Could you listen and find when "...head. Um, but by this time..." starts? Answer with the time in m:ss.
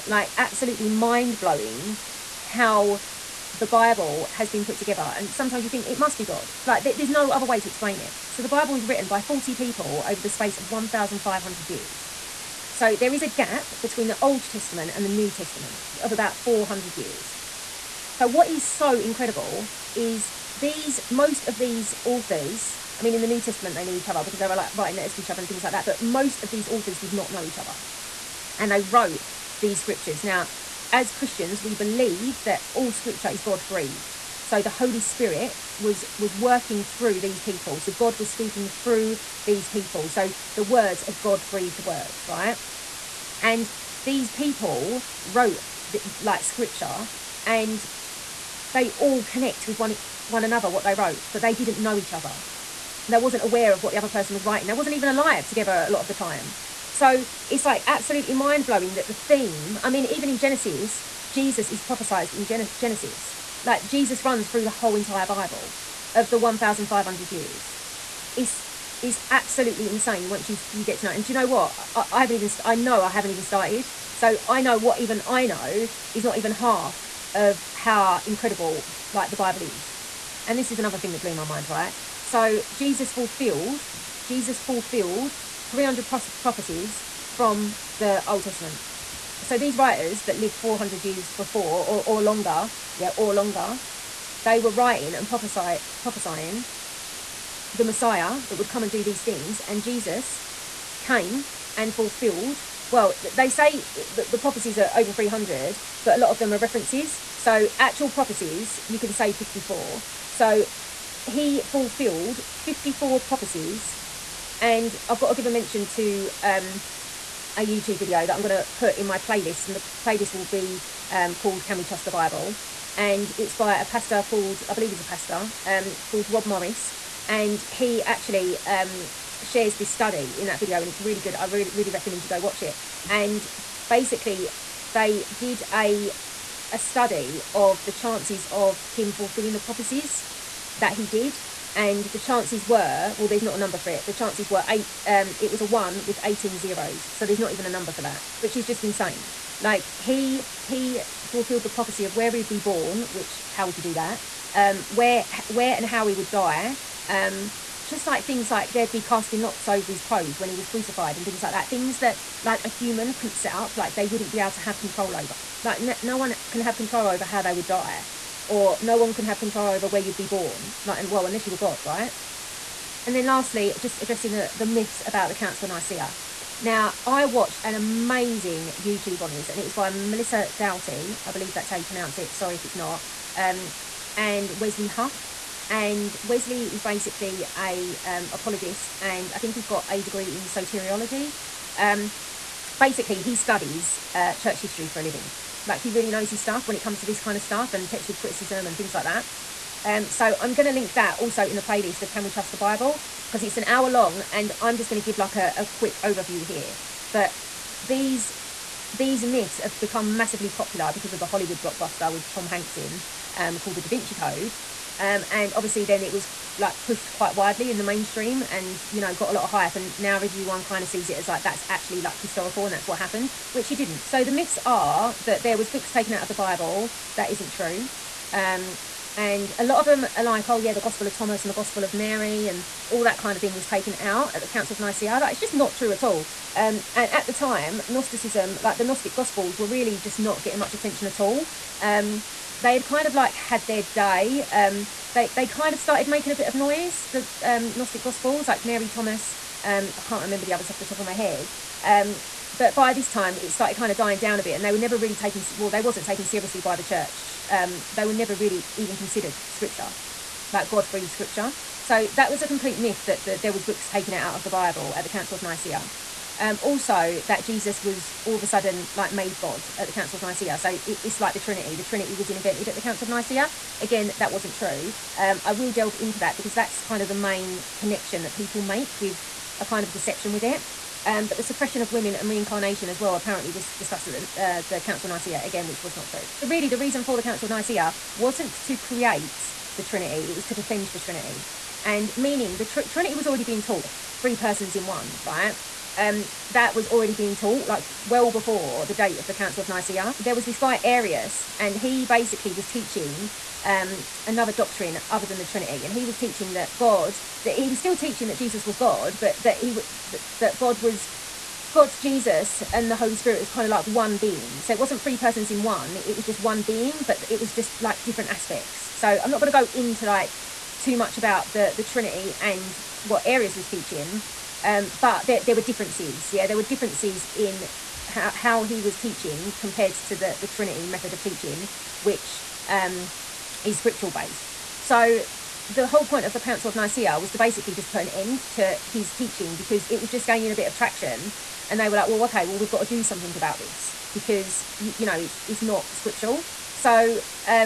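4:11.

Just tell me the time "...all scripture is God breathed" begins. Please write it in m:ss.
0:32.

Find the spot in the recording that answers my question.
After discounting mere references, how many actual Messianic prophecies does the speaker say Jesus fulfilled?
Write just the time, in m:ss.
1:50.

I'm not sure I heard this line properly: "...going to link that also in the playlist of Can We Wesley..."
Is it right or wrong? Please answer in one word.
wrong.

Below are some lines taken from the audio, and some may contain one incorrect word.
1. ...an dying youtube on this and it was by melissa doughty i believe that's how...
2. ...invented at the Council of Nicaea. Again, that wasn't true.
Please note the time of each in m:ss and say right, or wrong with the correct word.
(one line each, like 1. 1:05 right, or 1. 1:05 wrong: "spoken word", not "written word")
1. 2:57 wrong: "amazing", not "dying"
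2. 4:32 right.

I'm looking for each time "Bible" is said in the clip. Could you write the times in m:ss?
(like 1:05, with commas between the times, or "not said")
0:03, 0:08, 1:05, 1:19, 2:02, 3:22, 3:46, 4:24.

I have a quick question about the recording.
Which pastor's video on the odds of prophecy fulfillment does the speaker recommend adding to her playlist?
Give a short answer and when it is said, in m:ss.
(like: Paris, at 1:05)
Rob Morris, at 2:06.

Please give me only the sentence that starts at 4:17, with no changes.
Um, they were never really even considered scripture, like God-breathed scripture.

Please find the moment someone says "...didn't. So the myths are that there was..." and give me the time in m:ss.
3:43.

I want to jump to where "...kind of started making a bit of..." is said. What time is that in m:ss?
4:05.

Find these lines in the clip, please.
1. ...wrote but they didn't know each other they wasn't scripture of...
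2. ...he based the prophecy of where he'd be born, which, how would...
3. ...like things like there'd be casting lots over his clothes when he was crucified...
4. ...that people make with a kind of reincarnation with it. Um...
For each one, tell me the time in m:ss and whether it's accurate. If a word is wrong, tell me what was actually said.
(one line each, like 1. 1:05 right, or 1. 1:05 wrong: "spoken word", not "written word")
1. 0:50 wrong: "aware", not "scripture"
2. 2:30 wrong: "fulfilled", not "based"
3. 2:38 right
4. 4:38 wrong: "deception", not "reincarnation".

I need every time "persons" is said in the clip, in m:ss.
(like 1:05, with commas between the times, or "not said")
0:54, 4:54, 5:15.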